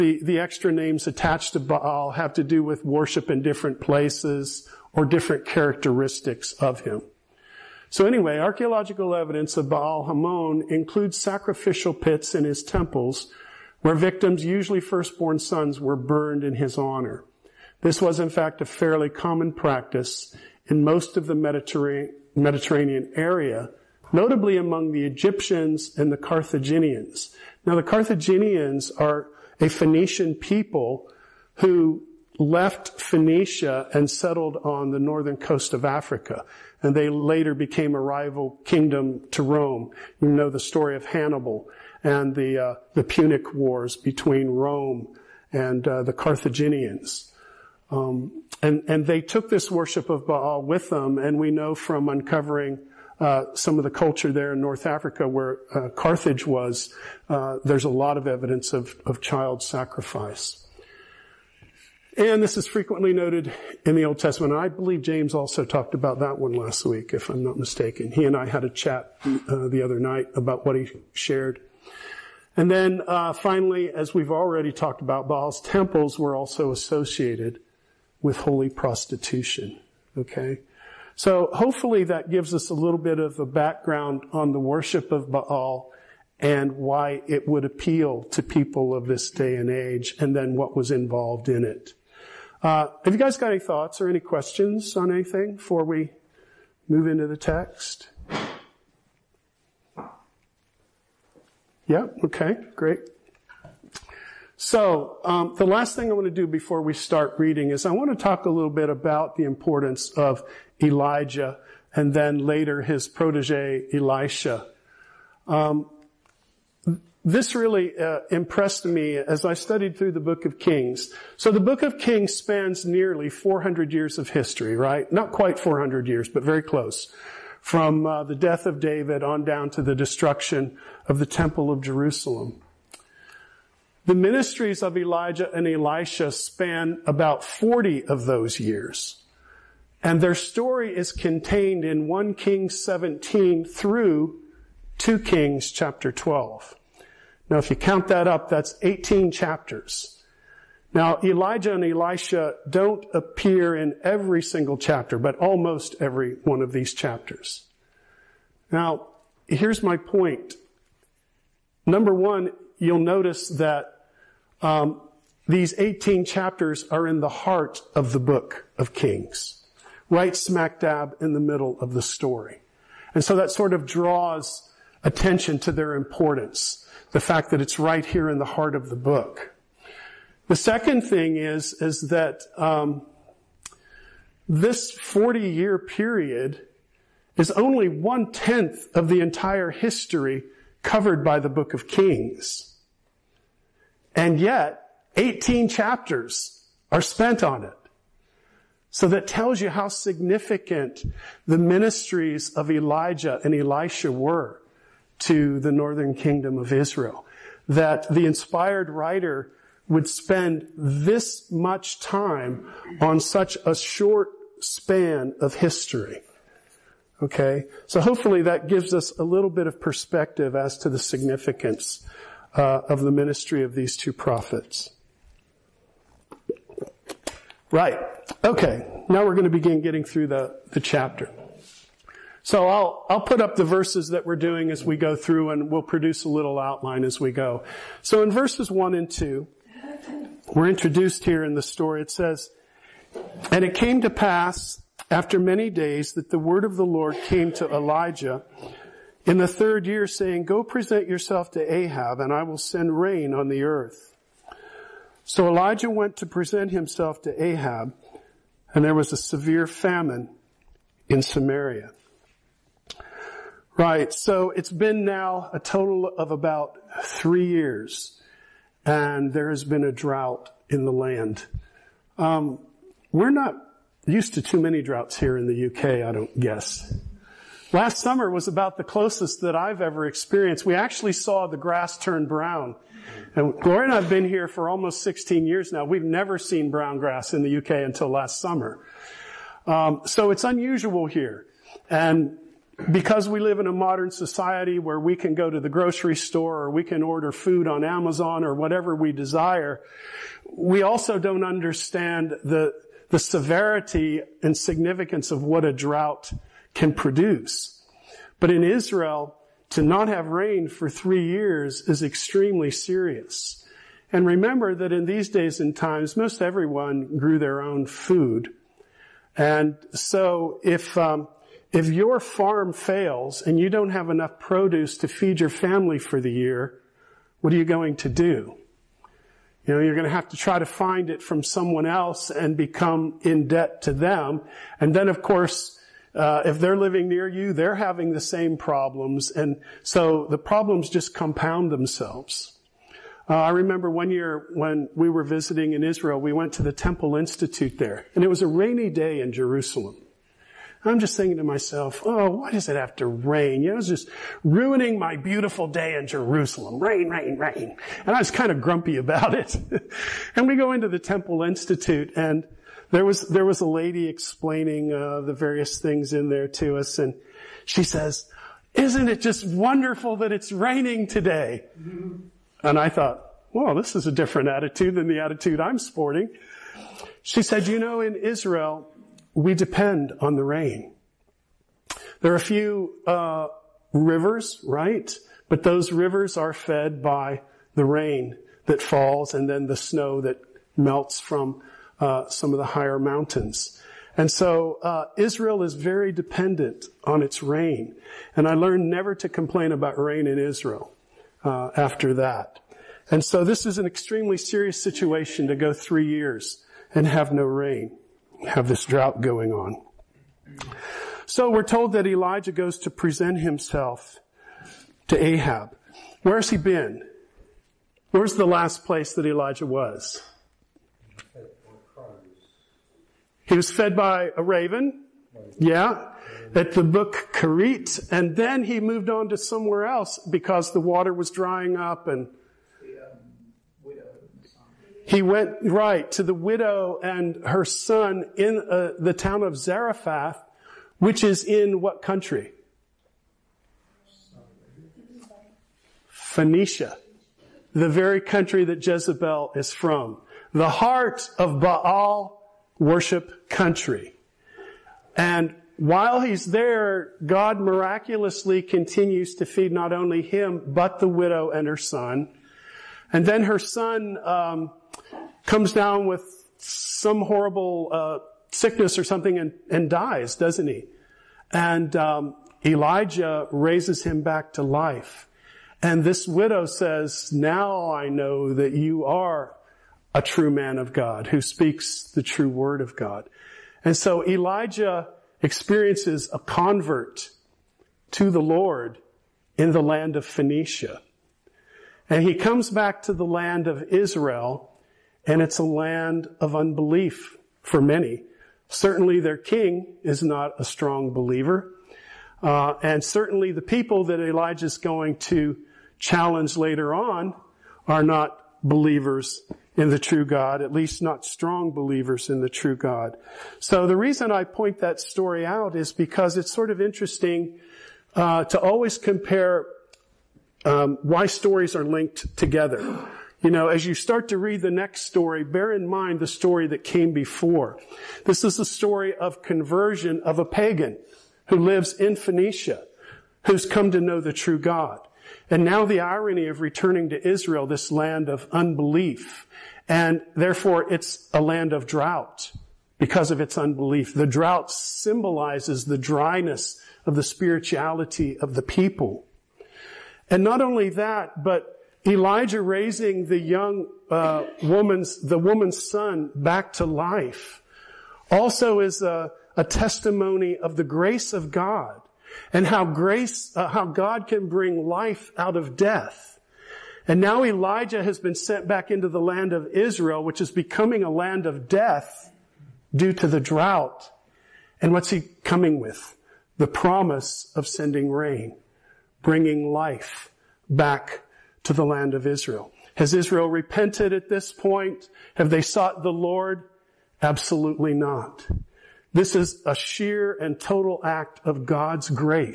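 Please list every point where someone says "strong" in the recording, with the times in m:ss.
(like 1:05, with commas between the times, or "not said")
8:20, 8:31.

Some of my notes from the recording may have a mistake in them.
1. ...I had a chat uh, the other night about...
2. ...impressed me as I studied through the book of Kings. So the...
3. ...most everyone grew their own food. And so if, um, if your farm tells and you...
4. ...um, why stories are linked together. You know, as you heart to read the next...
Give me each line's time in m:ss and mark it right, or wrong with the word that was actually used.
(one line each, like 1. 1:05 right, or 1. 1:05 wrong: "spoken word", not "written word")
1. 1:08 right
2. 1:58 right
3. 5:16 wrong: "fails", not "tells"
4. 8:40 wrong: "start", not "heart".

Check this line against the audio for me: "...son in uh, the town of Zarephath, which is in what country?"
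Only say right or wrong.
right.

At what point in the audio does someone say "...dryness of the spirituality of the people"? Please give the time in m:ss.
9:05.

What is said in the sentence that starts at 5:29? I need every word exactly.
You know, you're going to have to try to find it from someone else and become in debt to them.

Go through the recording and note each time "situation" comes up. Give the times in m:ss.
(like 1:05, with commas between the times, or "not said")
6:44.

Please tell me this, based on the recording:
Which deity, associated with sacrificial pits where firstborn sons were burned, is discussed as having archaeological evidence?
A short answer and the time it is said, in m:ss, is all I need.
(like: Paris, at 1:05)
Baal Hamon, at 0:09.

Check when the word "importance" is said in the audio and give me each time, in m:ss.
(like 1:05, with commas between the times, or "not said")
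1:49, 2:55.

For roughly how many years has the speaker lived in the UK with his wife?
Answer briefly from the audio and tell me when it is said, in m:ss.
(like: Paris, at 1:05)
16, at 4:45.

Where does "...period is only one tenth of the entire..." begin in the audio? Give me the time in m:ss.
3:05.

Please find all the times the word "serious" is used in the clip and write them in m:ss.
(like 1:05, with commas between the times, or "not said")
5:12, 6:44.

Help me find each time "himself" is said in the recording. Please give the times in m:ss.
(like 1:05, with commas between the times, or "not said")
4:16, 6:53.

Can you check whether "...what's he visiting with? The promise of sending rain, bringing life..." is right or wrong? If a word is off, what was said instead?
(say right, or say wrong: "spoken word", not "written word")
wrong: "coming", not "visiting".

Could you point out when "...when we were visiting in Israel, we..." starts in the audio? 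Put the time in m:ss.
5:44.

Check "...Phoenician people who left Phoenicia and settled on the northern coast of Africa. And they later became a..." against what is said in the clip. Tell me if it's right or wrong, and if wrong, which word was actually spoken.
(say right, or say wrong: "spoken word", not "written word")
right.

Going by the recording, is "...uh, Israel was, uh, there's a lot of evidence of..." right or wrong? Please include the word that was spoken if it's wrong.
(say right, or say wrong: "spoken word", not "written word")
wrong: "Carthage", not "Israel".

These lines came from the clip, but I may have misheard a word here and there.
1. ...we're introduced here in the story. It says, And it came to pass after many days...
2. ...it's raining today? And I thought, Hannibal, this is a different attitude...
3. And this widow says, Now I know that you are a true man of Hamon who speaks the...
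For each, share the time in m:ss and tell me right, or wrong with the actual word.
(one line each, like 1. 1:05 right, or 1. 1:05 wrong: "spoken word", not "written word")
1. 4:00 right
2. 6:10 wrong: "Well", not "Hannibal"
3. 7:55 wrong: "God", not "Hamon".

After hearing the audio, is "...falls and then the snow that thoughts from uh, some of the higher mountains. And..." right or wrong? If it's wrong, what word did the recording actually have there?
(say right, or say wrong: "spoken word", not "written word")
wrong: "melts", not "thoughts".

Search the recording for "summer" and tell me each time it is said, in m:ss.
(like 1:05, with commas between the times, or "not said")
4:37, 4:48.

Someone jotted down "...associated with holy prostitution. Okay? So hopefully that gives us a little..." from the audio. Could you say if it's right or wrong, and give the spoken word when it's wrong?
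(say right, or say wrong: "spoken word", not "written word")
right.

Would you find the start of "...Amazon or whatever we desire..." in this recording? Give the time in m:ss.
4:57.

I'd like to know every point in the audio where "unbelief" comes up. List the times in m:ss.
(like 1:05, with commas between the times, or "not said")
8:16, 8:58, 9:03.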